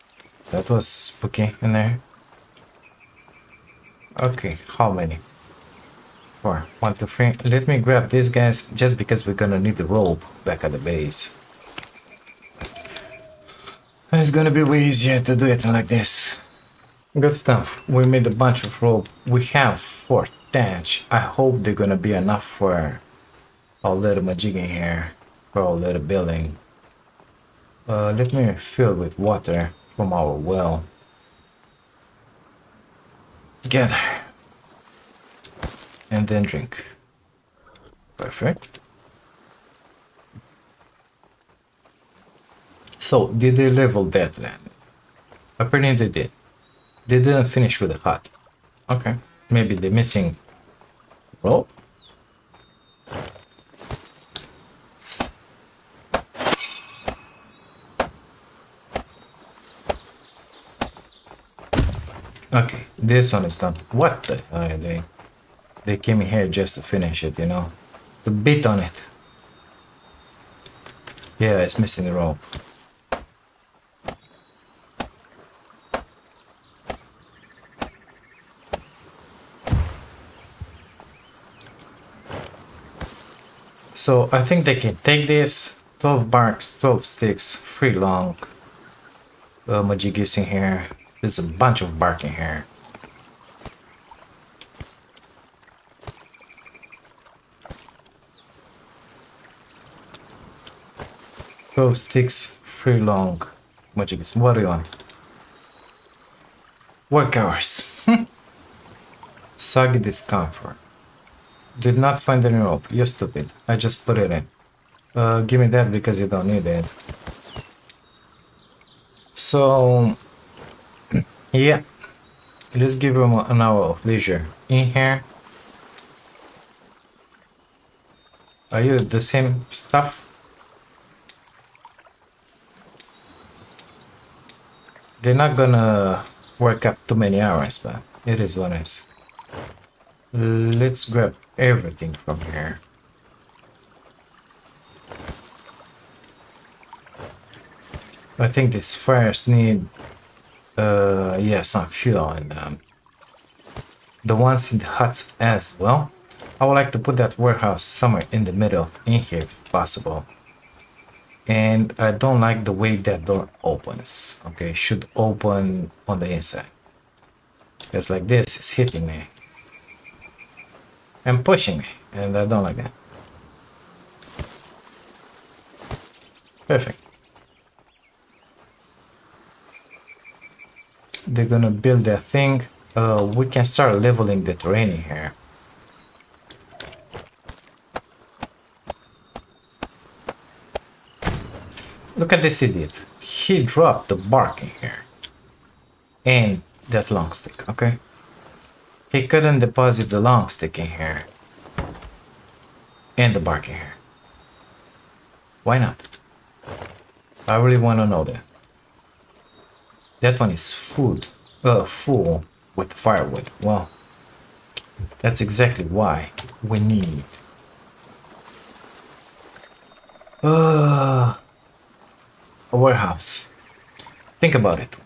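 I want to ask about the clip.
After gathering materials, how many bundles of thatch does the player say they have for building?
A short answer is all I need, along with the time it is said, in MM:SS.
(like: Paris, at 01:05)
4, at 00:19.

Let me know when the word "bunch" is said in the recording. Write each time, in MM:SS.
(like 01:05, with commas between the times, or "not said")
00:18, 01:31.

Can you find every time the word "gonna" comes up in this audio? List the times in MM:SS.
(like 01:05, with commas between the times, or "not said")
00:09, 00:14, 00:21, 02:15, 03:01.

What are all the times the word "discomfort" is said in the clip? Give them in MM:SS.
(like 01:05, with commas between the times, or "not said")
01:49.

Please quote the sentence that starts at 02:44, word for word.
Okay, should open on the inside.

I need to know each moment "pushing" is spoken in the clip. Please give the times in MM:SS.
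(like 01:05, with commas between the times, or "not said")
02:51.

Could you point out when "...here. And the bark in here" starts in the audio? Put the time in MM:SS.
03:20.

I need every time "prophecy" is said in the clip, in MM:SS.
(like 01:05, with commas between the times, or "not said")
not said.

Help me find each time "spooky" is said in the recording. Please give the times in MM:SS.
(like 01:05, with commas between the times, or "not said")
00:00.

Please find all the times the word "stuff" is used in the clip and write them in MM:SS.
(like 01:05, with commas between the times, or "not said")
00:17, 02:09.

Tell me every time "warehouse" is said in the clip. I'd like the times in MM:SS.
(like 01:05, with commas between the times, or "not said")
02:37, 03:42.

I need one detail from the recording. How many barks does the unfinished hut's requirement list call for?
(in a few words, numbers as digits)
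12.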